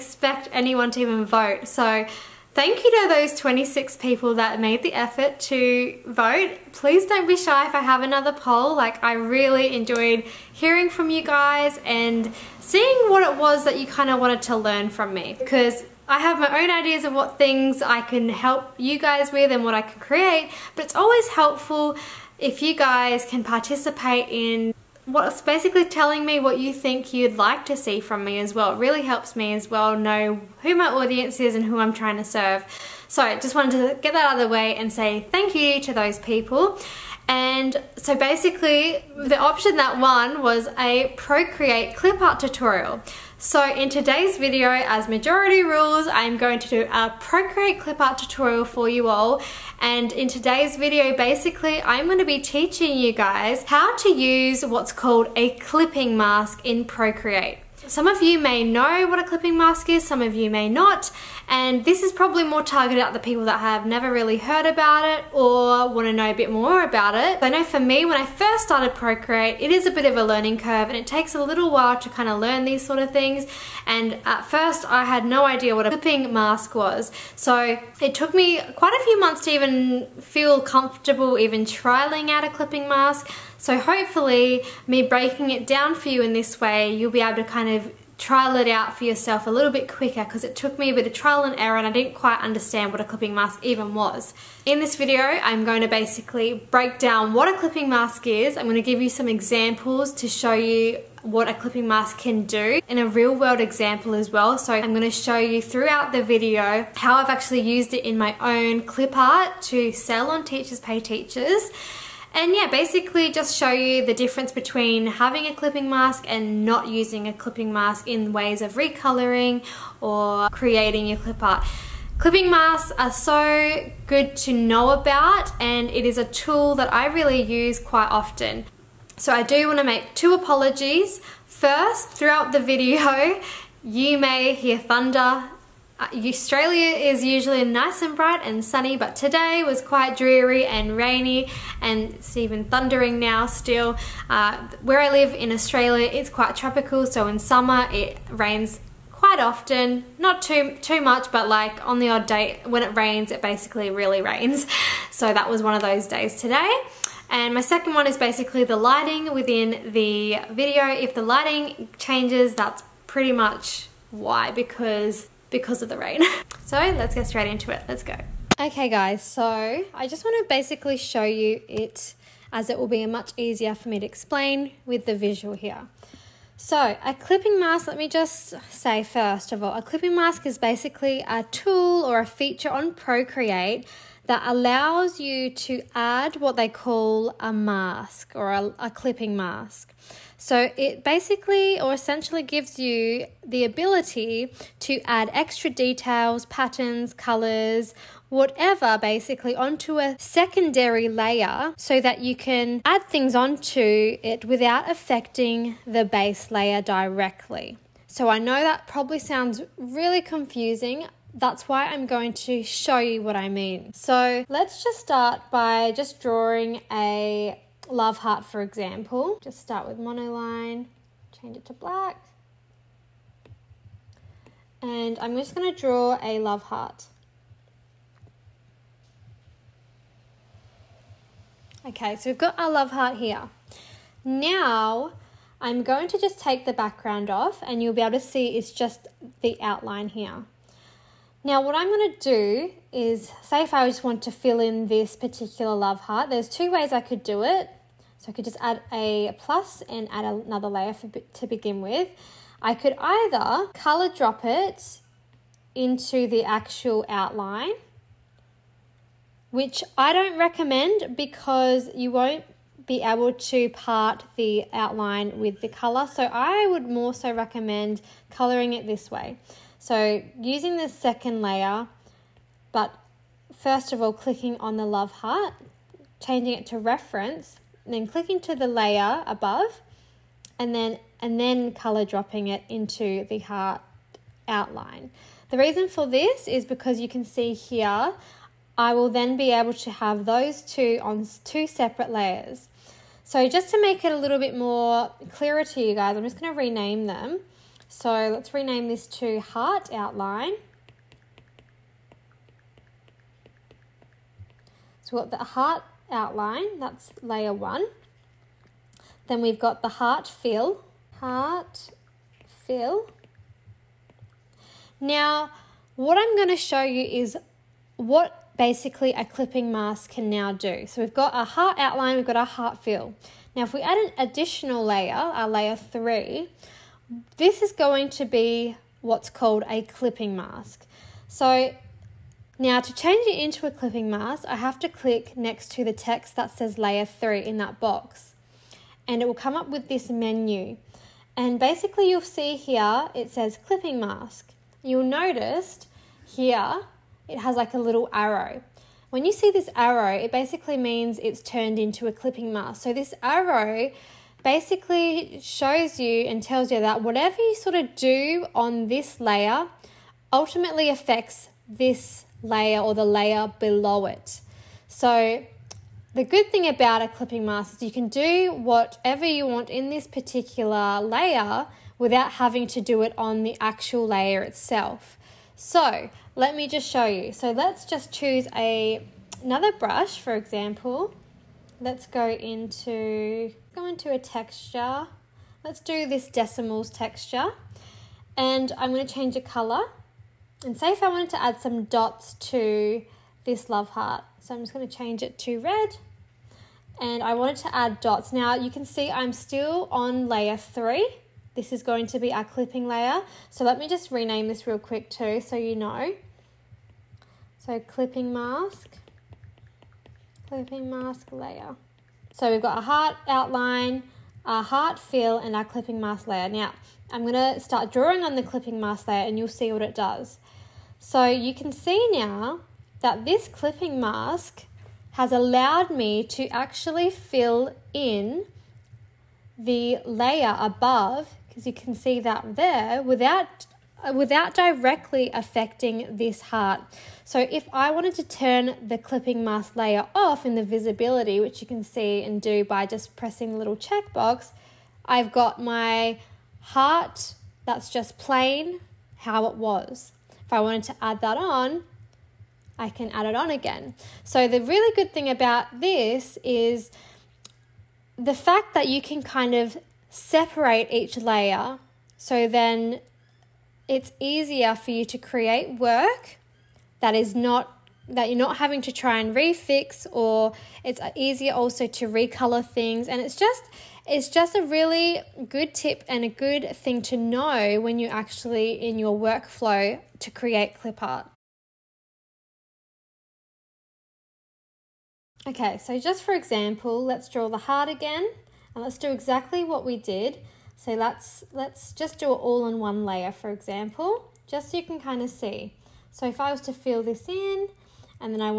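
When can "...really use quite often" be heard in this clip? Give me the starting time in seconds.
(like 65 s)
127 s.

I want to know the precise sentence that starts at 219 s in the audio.
Just start with monoline, change it to black.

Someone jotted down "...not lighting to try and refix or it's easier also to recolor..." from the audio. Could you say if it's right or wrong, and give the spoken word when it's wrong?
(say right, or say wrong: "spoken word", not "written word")
wrong: "having", not "lighting".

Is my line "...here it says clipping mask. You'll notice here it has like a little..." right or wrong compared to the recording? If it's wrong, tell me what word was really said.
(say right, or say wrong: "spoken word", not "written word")
right.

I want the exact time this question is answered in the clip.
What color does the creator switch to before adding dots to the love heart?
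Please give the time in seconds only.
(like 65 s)
395 s.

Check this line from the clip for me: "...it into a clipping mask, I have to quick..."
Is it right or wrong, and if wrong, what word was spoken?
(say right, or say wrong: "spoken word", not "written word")
wrong: "click", not "quick".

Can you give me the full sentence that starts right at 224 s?
And I'm just going to draw a love heart.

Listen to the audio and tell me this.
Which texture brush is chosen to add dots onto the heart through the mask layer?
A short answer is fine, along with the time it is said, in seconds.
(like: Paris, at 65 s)
Decimals texture, at 386 s.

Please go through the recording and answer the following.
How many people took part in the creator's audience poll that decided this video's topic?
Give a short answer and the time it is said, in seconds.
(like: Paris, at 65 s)
26, at 3 s.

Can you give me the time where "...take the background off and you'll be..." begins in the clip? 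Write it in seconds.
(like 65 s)
236 s.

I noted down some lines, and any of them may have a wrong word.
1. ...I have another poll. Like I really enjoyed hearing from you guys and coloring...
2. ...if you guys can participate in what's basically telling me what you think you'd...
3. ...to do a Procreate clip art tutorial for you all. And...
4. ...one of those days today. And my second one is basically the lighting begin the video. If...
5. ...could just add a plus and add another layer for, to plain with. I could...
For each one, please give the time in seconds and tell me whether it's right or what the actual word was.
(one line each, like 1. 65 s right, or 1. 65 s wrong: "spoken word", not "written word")
1. 7 s wrong: "seeing", not "coloring"
2. 22 s right
3. 46 s right
4. 155 s wrong: "within", not "begin"
5. 248 s wrong: "begin", not "plain".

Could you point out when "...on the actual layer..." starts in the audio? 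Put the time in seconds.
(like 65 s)
373 s.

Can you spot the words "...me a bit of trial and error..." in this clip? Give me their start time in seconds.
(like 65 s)
90 s.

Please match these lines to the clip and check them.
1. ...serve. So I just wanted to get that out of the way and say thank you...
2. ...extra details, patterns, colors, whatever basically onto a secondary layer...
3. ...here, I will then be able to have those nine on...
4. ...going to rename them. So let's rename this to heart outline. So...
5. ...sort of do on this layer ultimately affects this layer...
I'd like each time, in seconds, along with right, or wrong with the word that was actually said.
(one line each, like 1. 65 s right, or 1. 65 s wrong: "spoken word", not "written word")
1. 32 s right
2. 195 s right
3. 287 s wrong: "two", not "nine"
4. 296 s right
5. 357 s right.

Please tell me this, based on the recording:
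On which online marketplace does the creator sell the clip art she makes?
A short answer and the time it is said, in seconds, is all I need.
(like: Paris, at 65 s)
Teachers Pay Teachers, at 110 s.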